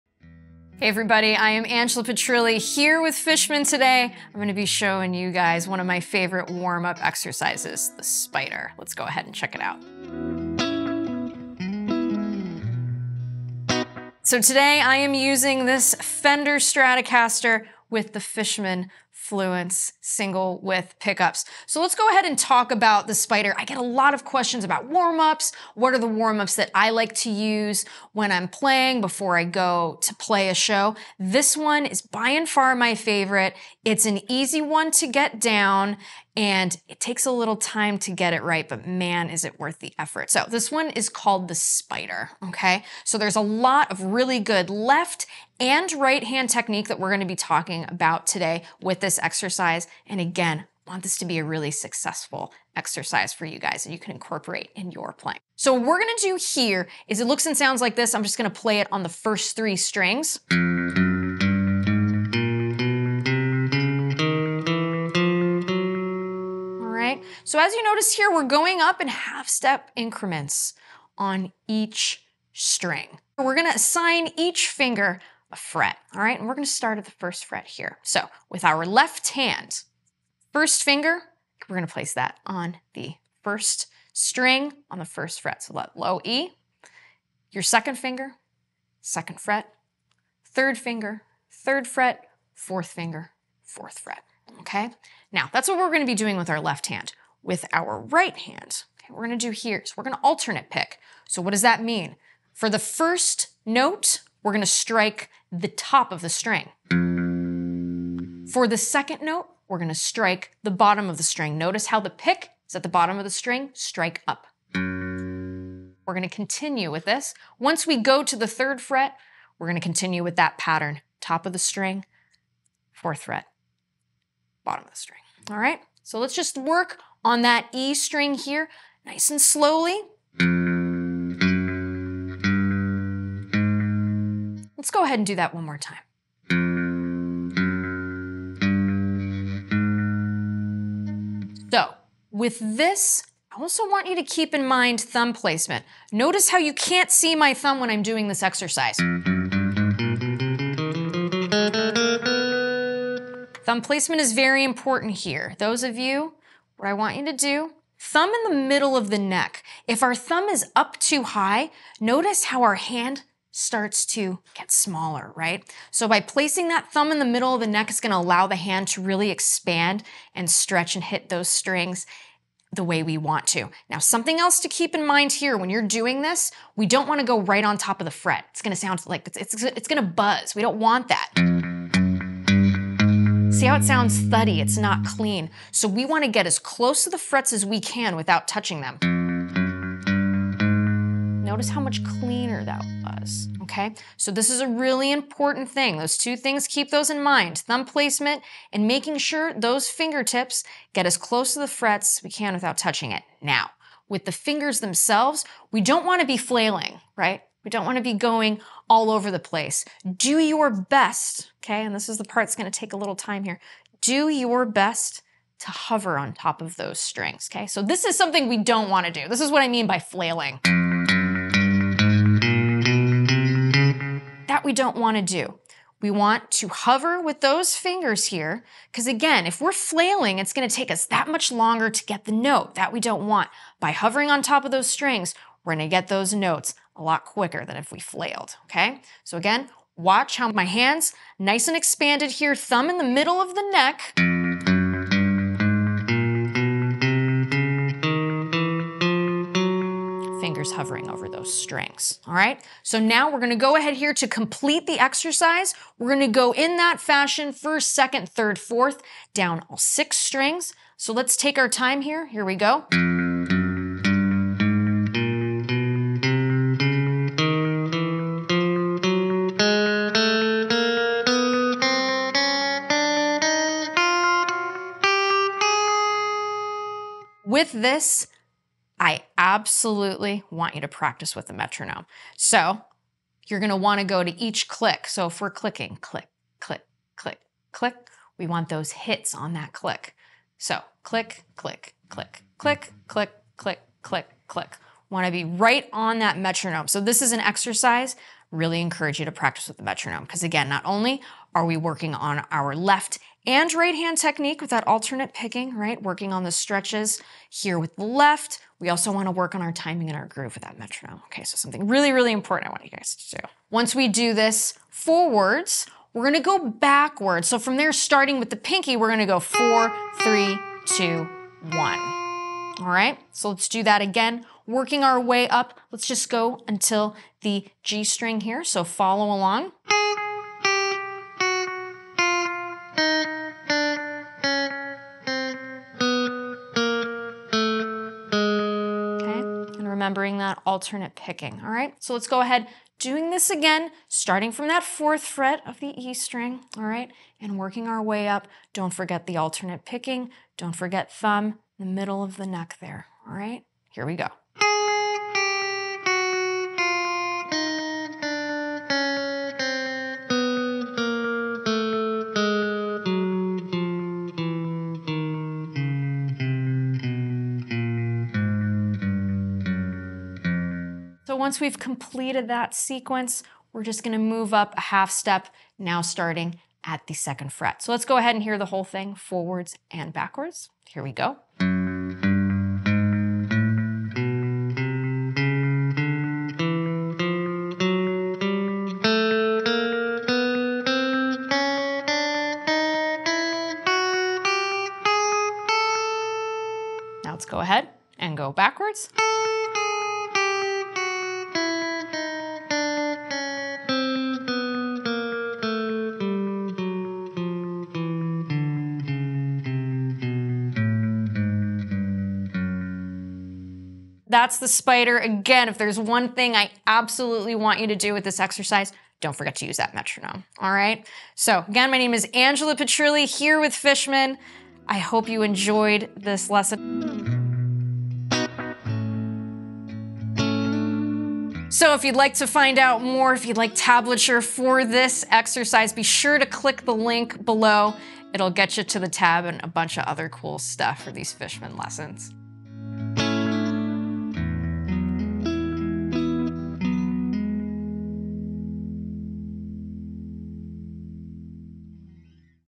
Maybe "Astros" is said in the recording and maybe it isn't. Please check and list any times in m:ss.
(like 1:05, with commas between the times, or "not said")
not said.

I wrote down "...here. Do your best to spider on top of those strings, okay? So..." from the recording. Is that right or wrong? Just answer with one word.
wrong.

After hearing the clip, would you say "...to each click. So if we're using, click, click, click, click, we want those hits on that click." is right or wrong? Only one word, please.
wrong.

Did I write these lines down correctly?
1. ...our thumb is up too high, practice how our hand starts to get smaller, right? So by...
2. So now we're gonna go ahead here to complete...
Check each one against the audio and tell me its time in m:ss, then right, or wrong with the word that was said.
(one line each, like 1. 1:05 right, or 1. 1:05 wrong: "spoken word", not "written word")
1. 2:40 wrong: "notice", not "practice"
2. 4:12 right.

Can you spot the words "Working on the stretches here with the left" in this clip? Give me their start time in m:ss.
5:06.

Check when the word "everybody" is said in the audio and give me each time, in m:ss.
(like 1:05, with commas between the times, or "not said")
0:00.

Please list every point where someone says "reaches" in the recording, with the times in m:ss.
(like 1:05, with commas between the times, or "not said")
not said.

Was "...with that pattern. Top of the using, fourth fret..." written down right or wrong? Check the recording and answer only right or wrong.
wrong.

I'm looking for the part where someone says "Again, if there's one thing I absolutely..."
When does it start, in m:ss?
6:55.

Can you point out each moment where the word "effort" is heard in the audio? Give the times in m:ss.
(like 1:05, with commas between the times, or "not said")
0:39.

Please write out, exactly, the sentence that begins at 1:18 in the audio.
So with our left hand, first finger, we're going to place that on the first string on the first fret.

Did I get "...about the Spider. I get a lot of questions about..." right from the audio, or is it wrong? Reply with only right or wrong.
right.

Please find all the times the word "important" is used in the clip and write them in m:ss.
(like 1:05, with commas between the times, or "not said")
2:34, 3:15, 5:12.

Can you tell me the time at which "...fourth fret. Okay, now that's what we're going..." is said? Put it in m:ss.
1:33.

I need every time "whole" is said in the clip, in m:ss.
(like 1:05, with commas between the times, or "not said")
6:18.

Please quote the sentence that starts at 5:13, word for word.
Once we do this forwards, we're going to go backwards.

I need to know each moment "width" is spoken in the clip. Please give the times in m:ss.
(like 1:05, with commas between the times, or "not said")
0:20.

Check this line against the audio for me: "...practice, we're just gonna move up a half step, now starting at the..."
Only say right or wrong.
wrong.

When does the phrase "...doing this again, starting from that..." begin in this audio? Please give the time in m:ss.
5:42.